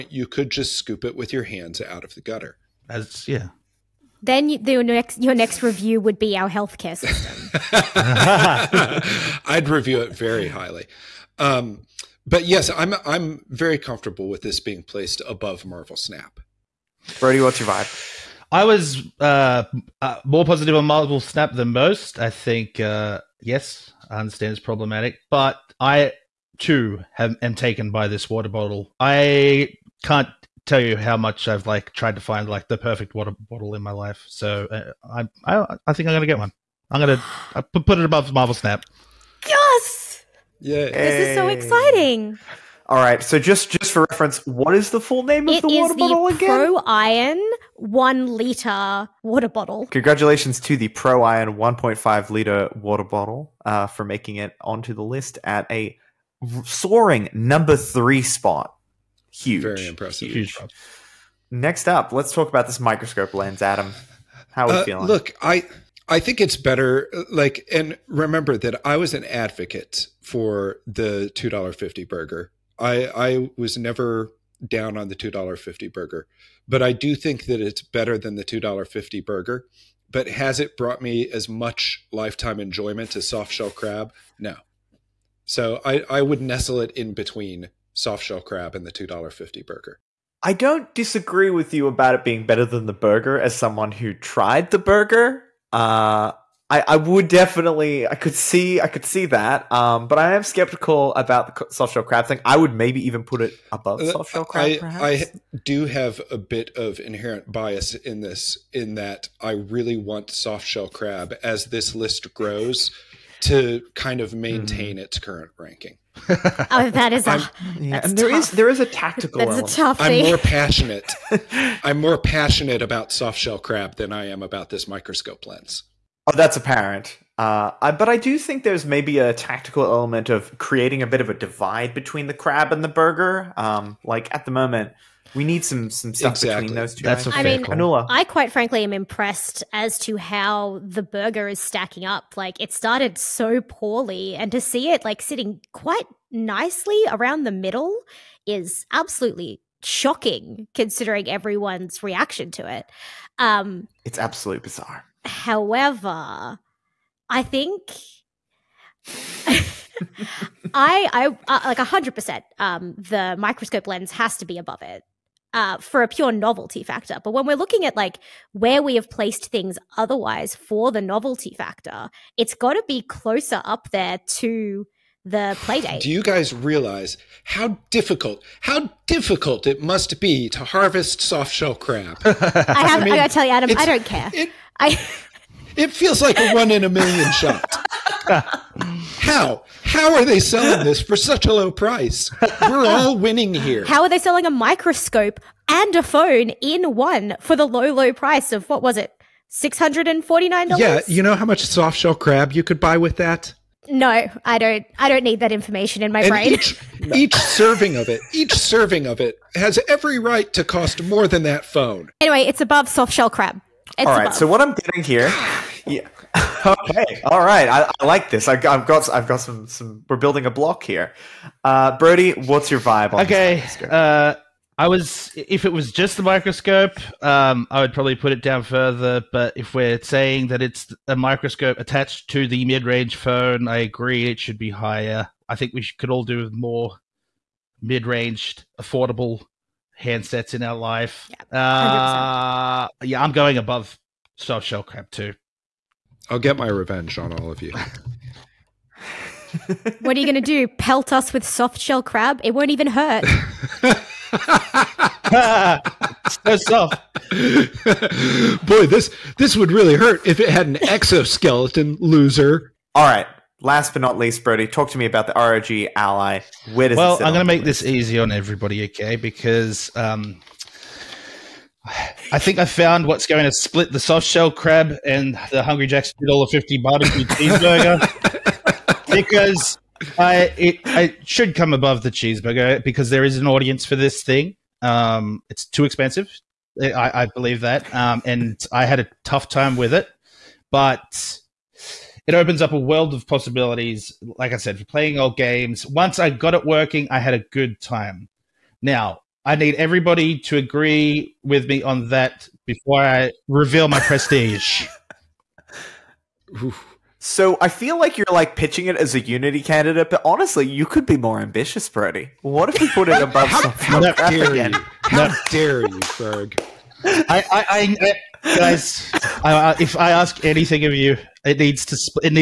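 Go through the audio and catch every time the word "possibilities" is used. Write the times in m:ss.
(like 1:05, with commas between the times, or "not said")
4:53.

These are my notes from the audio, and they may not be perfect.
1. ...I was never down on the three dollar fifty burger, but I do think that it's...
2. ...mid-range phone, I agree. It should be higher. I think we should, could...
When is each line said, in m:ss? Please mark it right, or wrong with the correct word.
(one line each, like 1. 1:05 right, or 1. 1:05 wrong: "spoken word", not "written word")
1. 1:13 wrong: "two", not "three"
2. 3:52 right.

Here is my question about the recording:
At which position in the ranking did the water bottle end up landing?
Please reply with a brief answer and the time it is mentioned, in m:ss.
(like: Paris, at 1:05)
3, at 0:57.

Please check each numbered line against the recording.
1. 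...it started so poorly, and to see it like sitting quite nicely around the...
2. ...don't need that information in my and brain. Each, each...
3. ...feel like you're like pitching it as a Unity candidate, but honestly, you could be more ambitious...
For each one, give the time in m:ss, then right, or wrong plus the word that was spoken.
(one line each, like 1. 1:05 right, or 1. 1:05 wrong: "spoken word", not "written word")
1. 2:22 right
2. 3:25 right
3. 5:07 right.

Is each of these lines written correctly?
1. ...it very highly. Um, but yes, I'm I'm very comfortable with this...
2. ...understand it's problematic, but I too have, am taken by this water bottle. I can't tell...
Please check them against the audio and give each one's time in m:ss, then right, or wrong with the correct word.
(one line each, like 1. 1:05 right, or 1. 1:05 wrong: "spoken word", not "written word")
1. 0:09 right
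2. 0:24 right.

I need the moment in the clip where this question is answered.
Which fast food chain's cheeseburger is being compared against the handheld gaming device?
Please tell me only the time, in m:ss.
4:35.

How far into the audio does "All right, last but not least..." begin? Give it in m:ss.
4:22.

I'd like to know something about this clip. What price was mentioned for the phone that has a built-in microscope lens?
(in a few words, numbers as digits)
$649.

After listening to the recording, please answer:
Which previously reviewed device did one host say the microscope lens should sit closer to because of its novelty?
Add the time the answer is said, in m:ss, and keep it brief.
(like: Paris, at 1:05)
Playdate, at 2:55.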